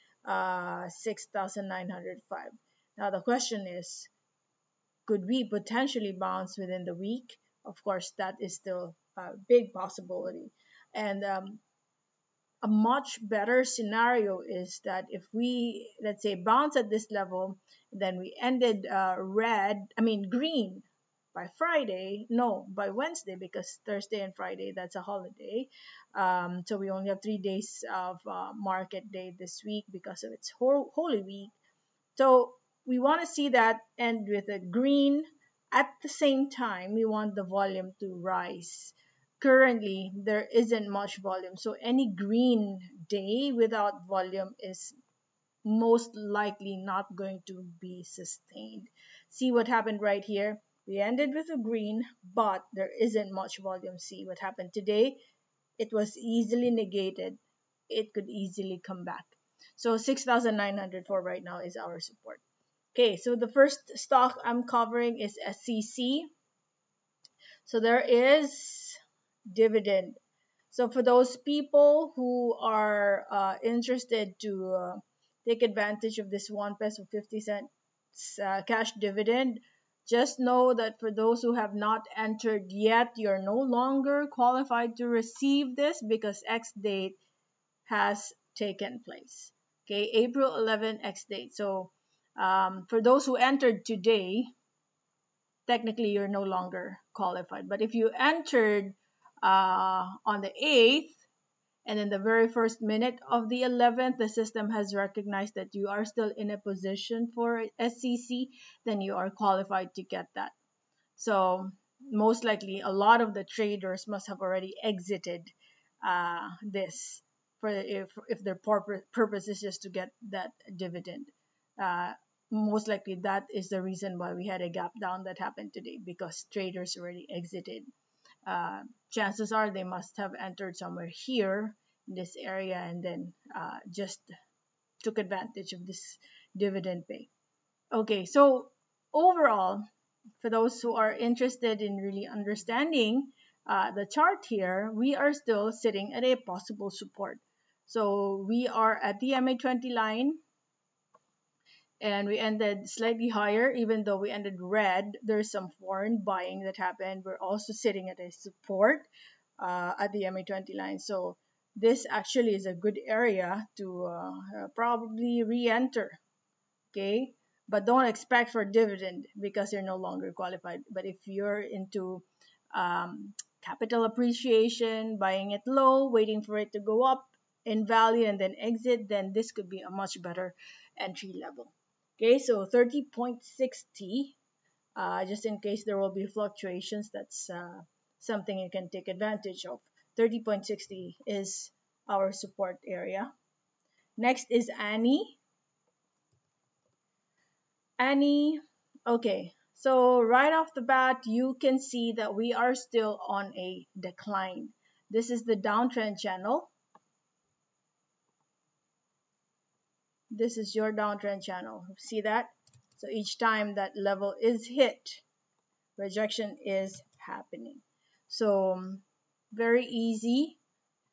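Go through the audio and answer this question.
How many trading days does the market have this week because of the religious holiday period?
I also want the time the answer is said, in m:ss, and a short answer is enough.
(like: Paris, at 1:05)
3, at 0:27.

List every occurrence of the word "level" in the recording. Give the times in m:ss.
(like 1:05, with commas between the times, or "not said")
0:17, 3:01, 3:33.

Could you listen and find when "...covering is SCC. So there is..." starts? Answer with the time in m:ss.
1:04.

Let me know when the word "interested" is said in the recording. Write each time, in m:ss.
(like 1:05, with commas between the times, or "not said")
1:13, 2:21.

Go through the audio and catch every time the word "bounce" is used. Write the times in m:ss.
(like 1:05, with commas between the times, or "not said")
0:06, 0:16.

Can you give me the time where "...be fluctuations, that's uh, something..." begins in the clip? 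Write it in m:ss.
3:06.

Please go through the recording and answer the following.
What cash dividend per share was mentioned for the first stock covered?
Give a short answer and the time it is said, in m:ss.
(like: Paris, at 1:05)
1.50 pesos, at 1:16.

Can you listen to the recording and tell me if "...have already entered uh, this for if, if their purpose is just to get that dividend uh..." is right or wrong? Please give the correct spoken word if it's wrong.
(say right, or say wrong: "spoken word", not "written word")
wrong: "exited", not "entered".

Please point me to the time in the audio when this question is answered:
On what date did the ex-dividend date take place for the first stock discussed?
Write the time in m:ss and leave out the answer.
1:30.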